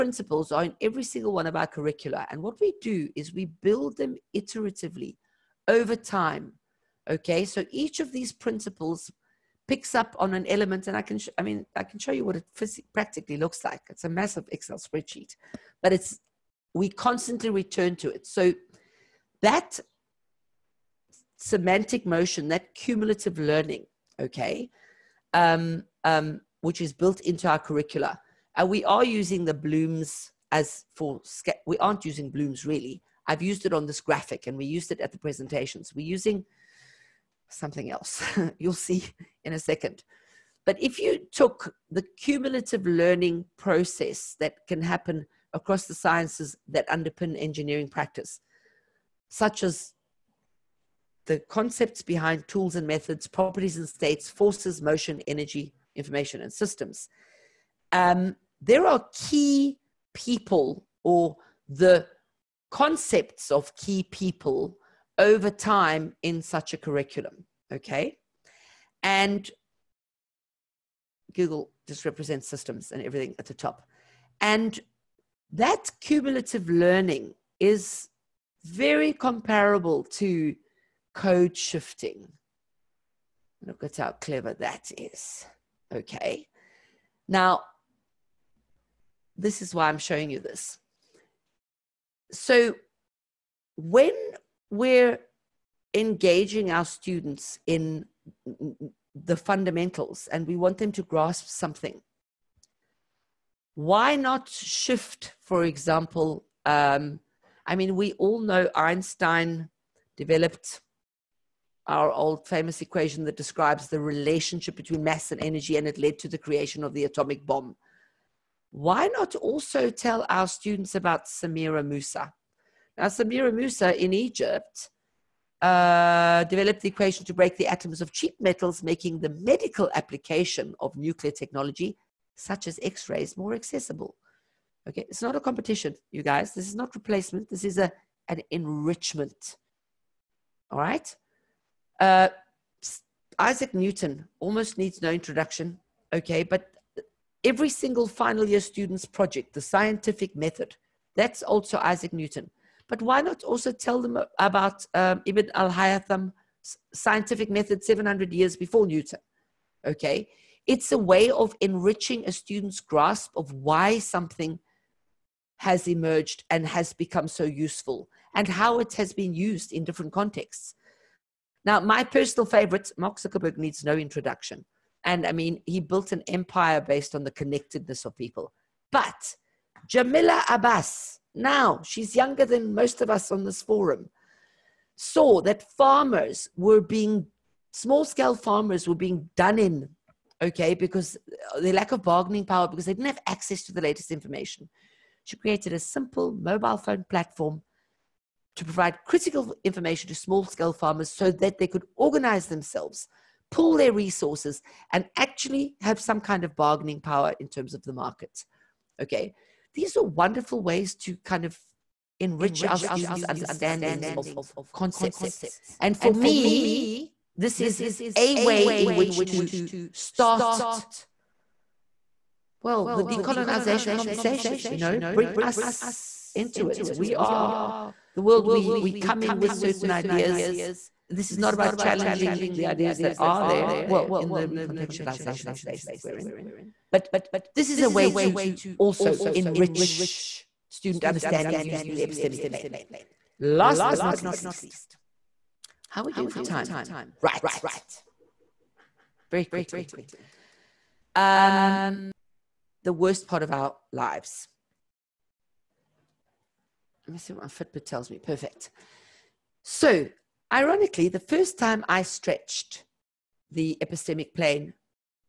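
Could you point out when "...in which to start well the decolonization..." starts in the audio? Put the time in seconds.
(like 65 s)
218 s.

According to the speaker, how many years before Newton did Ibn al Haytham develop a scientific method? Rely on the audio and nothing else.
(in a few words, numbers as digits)
700.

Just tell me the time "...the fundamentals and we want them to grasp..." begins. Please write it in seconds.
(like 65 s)
99 s.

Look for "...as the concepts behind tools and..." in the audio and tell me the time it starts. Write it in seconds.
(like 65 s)
49 s.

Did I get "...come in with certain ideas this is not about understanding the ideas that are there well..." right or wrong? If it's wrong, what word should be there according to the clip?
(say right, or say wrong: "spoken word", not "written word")
wrong: "challenging", not "understanding".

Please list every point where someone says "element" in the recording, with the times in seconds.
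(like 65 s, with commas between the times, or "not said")
10 s.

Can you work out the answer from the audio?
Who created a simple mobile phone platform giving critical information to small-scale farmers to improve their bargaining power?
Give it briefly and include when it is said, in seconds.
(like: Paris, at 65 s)
Jamila Abbas, at 179 s.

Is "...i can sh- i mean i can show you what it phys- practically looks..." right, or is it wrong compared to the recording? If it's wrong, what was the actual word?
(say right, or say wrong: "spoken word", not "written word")
right.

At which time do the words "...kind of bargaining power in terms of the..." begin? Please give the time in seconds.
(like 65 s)
206 s.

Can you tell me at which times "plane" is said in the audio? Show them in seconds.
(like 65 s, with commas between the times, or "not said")
242 s, 264 s.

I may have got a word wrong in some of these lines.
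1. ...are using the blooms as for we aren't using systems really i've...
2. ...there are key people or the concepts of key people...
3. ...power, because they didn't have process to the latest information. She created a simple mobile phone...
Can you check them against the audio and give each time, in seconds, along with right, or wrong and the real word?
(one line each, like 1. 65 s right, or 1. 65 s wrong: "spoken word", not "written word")
1. 28 s wrong: "blooms", not "systems"
2. 58 s right
3. 192 s wrong: "access", not "process".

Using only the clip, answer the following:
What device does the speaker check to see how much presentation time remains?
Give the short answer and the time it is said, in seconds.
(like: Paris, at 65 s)
Fitbit, at 257 s.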